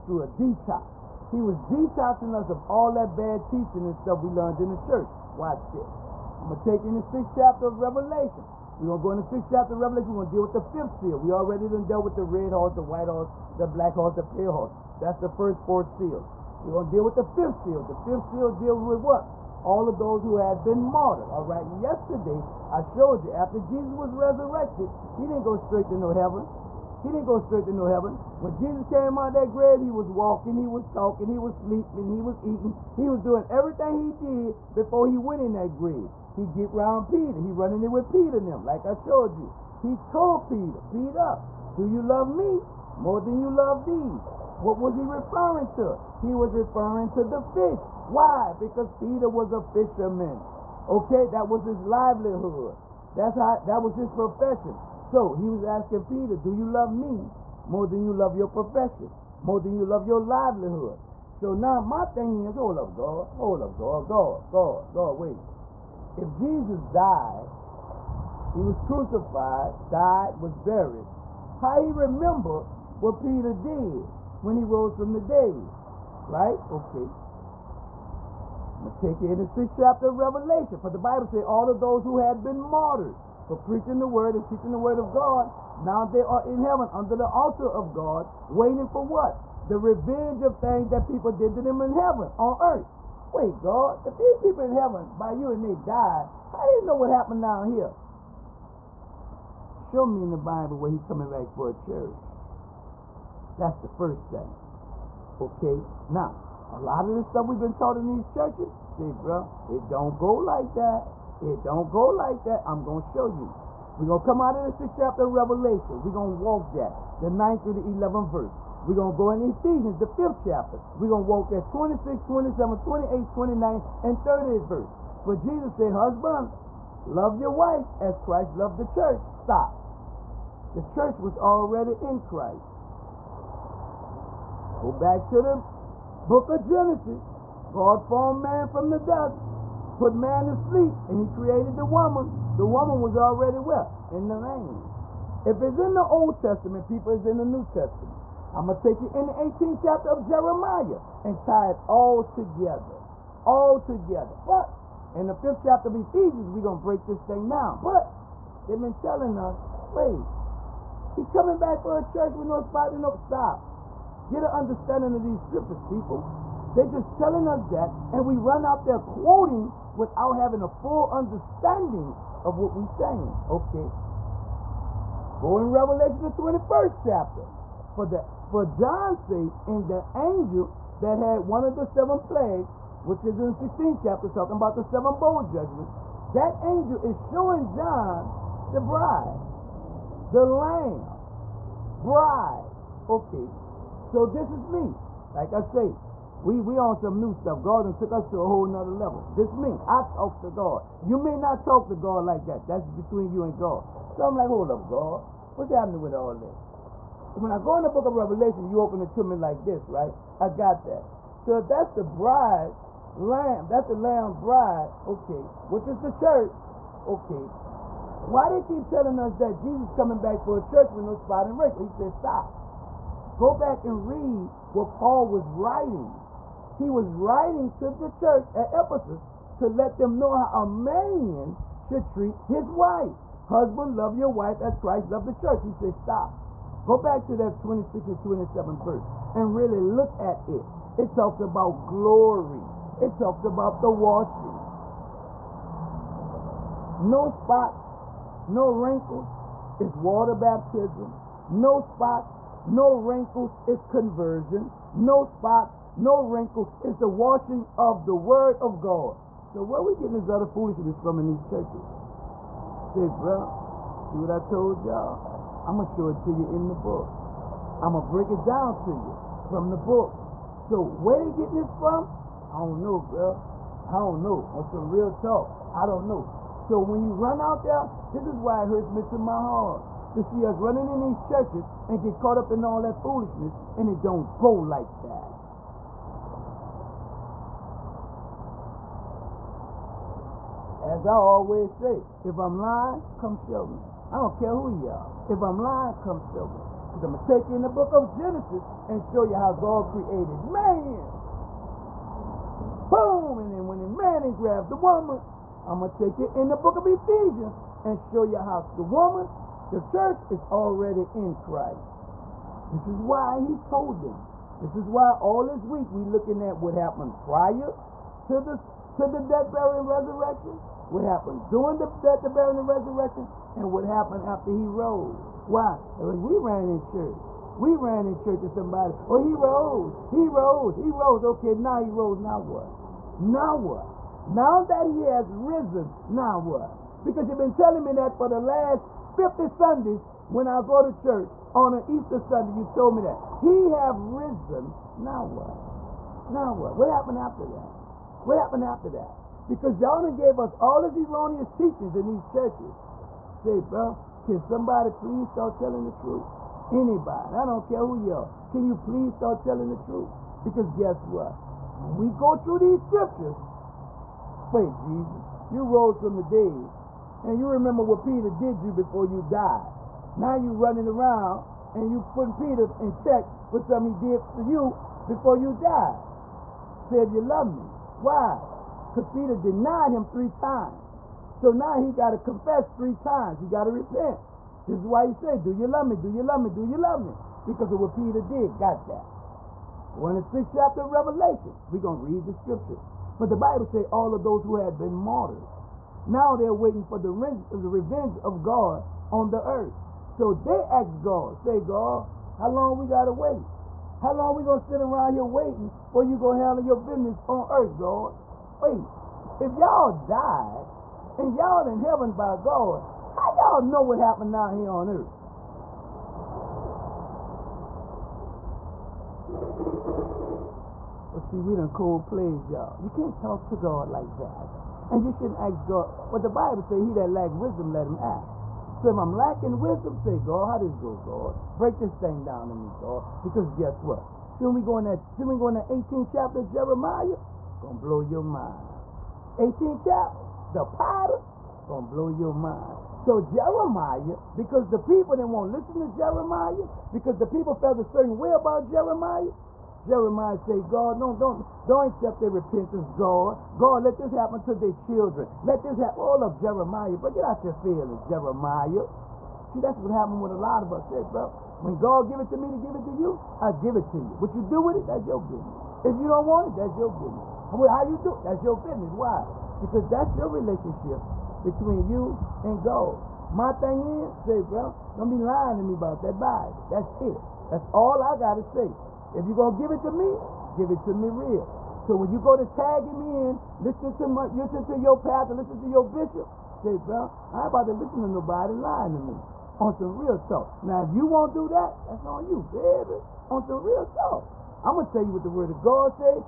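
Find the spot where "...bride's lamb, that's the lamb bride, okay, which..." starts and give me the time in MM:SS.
03:32.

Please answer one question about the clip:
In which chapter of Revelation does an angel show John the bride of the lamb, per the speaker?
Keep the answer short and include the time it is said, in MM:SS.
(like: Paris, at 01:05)
21st chapter, at 02:55.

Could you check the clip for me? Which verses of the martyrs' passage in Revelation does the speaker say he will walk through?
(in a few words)
9 through 11.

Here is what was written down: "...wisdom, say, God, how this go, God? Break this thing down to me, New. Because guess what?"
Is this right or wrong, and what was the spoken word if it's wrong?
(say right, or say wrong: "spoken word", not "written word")
wrong: "God", not "New".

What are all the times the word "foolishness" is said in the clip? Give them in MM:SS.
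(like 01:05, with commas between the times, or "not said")
04:20, 04:43.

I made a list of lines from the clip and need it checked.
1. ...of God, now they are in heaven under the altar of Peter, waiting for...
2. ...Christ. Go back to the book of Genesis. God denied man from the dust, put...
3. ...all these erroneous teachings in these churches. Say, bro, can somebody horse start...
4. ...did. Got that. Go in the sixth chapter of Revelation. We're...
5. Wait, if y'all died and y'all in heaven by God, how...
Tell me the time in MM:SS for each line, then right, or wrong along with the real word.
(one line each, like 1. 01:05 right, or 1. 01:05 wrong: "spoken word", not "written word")
1. 01:24 wrong: "God", not "Peter"
2. 02:12 wrong: "formed", not "denied"
3. 05:50 wrong: "please", not "horse"
4. 06:28 right
5. 06:48 right.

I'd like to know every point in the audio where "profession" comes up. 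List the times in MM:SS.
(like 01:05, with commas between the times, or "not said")
00:54, 00:58.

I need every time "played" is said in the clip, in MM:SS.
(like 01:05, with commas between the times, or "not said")
07:02.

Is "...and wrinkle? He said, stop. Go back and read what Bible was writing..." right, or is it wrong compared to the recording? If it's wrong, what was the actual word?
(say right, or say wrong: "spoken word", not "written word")
wrong: "Paul", not "Bible".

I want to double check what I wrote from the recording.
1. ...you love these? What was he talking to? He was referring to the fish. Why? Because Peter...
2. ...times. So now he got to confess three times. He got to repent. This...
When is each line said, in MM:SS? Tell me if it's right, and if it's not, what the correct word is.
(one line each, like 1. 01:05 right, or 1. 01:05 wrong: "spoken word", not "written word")
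1. 00:43 wrong: "referring", not "talking"
2. 06:20 right.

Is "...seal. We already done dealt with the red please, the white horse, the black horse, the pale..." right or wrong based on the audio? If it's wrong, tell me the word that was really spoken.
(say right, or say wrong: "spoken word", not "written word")
wrong: "horse", not "please".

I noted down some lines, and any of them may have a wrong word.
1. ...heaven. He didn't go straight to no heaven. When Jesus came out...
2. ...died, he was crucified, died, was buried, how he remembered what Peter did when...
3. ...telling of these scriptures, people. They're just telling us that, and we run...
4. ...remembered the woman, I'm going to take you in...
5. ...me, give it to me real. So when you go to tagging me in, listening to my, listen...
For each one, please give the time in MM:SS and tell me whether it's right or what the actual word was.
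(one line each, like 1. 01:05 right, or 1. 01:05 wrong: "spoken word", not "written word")
1. 00:26 right
2. 01:06 right
3. 02:44 wrong: "understanding", not "telling"
4. 05:04 wrong: "grabbed", not "remembered"
5. 07:59 right.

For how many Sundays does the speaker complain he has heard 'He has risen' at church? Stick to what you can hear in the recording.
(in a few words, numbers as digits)
50.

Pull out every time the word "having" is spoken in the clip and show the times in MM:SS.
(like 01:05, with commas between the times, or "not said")
02:50.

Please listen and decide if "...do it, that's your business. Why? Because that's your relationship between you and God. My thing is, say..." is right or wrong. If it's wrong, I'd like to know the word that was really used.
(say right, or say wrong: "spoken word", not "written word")
right.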